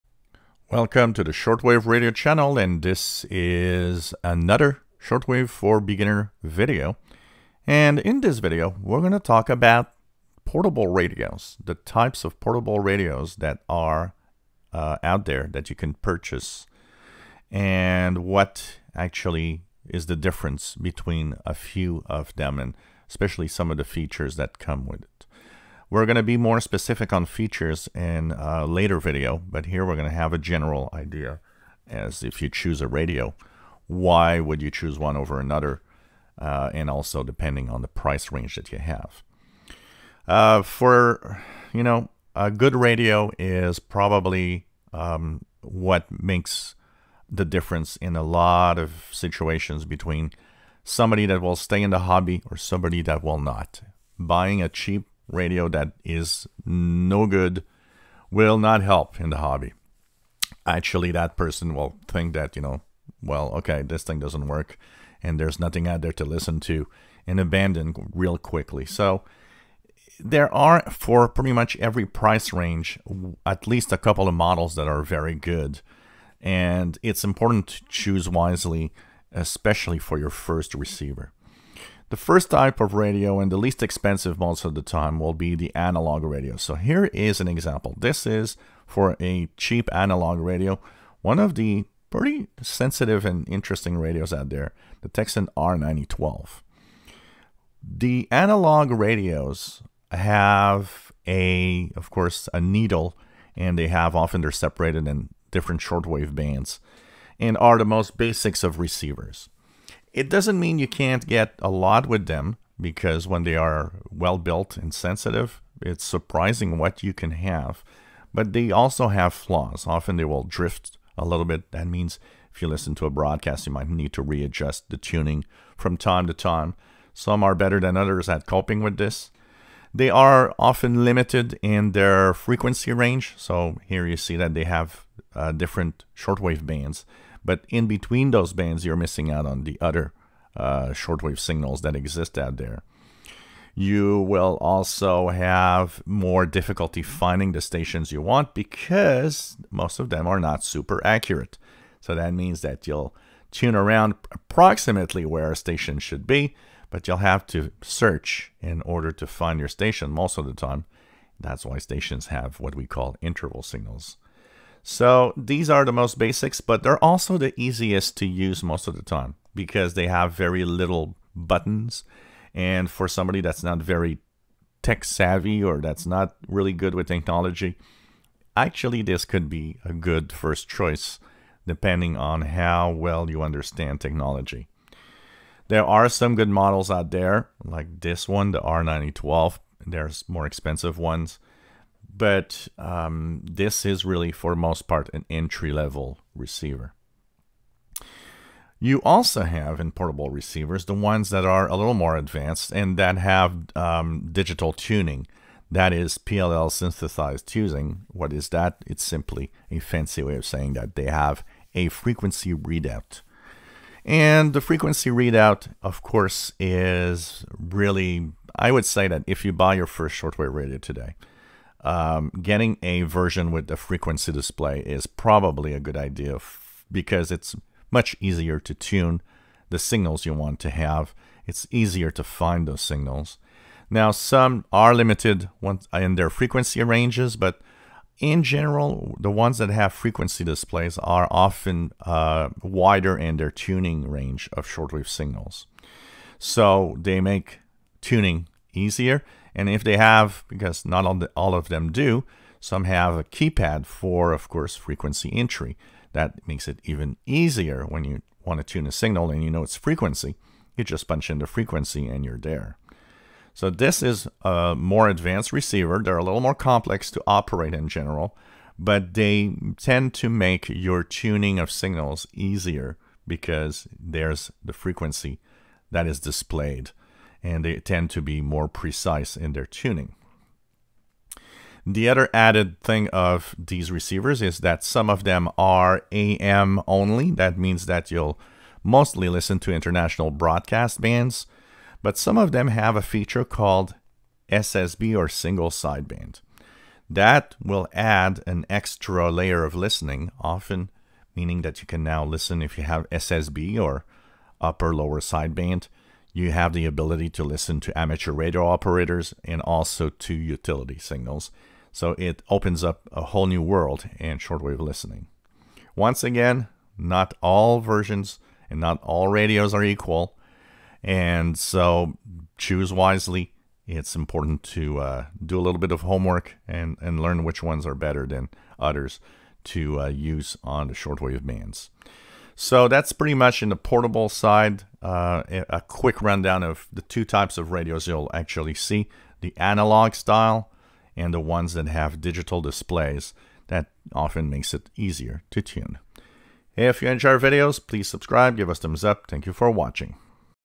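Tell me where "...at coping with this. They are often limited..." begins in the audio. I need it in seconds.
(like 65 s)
128 s.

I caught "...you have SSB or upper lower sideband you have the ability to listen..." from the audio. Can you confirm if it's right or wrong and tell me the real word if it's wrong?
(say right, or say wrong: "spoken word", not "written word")
right.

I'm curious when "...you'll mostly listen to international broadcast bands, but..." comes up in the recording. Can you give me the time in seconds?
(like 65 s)
288 s.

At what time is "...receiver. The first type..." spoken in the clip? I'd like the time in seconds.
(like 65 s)
80 s.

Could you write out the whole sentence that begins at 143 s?
You will also have more difficulty finding the stations you want because most of them are not super accurate.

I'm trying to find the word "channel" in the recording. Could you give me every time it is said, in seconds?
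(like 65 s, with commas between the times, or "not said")
2 s.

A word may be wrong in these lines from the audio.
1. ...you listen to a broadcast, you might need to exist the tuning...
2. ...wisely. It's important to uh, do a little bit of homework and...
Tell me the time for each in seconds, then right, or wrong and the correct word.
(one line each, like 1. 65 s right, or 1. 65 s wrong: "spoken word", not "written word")
1. 122 s wrong: "readjust", not "exist"
2. 322 s right.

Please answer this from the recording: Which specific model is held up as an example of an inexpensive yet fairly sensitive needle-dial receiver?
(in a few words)
Tecsun R9012.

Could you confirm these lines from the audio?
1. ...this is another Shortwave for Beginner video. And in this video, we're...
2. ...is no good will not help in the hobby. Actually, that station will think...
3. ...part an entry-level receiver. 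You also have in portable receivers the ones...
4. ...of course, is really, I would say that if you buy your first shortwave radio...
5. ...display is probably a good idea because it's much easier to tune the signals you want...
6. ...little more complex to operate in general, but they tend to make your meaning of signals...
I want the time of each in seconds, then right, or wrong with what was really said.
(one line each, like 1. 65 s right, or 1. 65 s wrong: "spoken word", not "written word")
1. 2 s right
2. 56 s wrong: "person", not "station"
3. 194 s right
4. 215 s right
5. 224 s right
6. 266 s wrong: "tuning", not "meaning".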